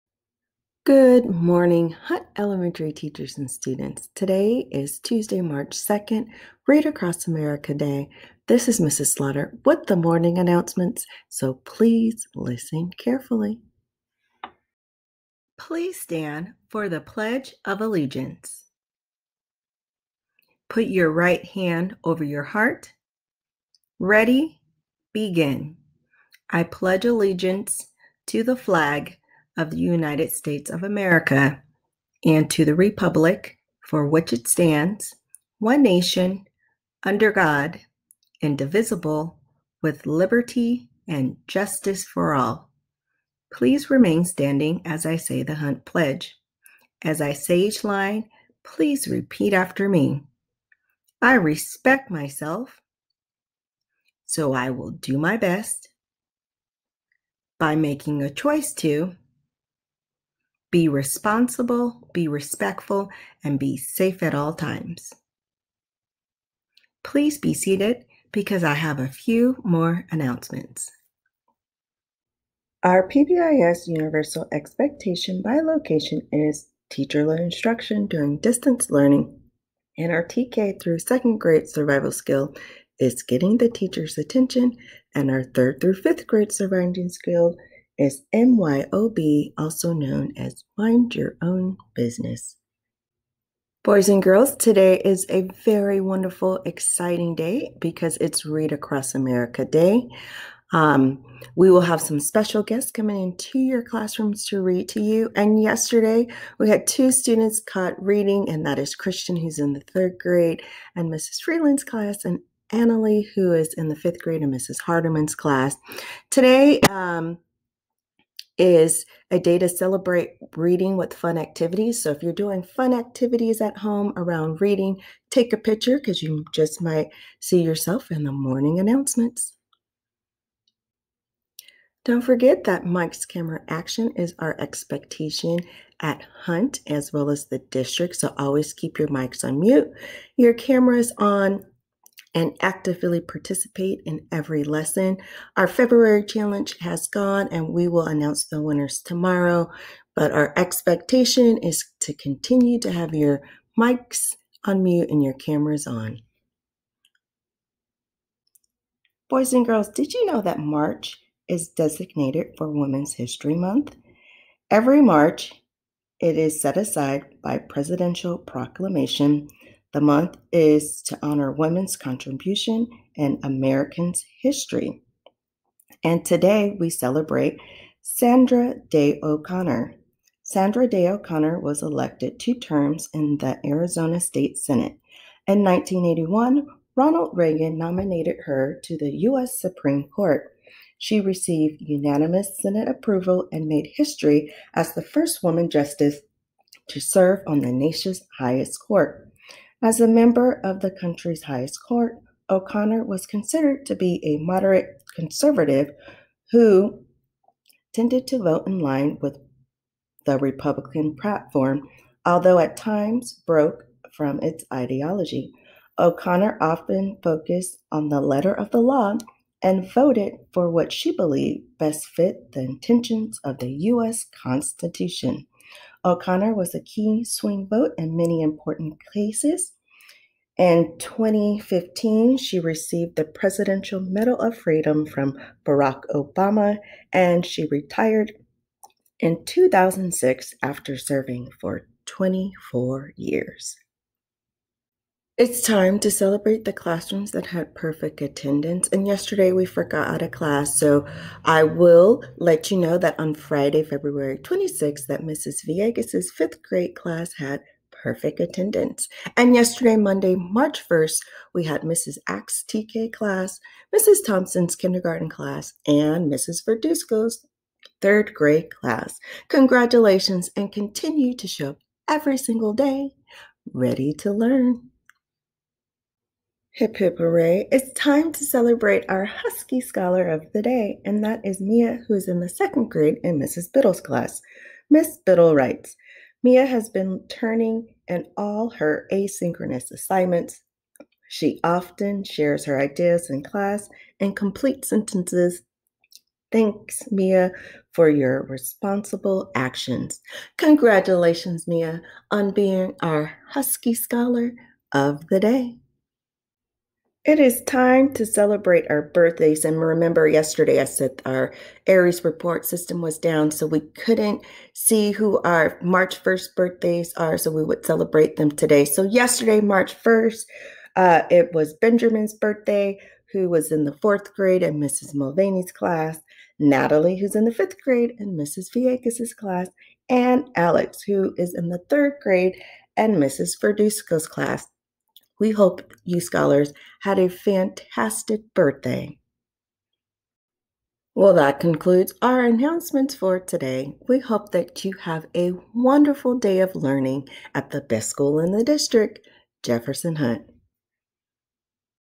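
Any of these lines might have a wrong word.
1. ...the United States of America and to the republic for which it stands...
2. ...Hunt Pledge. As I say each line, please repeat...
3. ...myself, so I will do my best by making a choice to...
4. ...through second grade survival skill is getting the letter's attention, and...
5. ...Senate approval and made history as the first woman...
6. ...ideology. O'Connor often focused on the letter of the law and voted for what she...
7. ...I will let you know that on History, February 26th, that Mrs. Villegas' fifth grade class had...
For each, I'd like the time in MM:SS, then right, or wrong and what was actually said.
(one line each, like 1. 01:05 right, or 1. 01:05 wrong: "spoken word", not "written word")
1. 00:29 right
2. 00:45 right
3. 00:52 right
4. 01:20 wrong: "teacher", not "letter"
5. 03:12 right
6. 03:34 right
7. 04:11 wrong: "Friday", not "History".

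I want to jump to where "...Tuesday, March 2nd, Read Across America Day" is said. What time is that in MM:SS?
00:04.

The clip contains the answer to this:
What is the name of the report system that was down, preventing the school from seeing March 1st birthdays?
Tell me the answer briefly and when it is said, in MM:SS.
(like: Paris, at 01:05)
Aeries, at 05:11.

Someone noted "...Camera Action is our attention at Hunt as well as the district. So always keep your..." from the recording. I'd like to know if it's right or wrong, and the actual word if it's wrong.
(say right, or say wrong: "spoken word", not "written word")
wrong: "expectation", not "attention".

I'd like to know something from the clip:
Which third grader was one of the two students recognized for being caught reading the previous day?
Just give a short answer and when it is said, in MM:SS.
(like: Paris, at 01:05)
Christian, at 01:48.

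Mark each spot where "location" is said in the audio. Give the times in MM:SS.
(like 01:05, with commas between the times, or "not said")
01:15.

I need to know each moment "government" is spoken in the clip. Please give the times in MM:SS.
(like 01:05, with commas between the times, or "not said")
not said.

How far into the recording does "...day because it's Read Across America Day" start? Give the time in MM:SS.
01:37.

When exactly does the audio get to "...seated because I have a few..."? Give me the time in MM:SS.
01:07.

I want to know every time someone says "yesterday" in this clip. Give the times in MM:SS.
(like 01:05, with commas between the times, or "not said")
01:45, 04:09, 04:19, 05:10, 05:19.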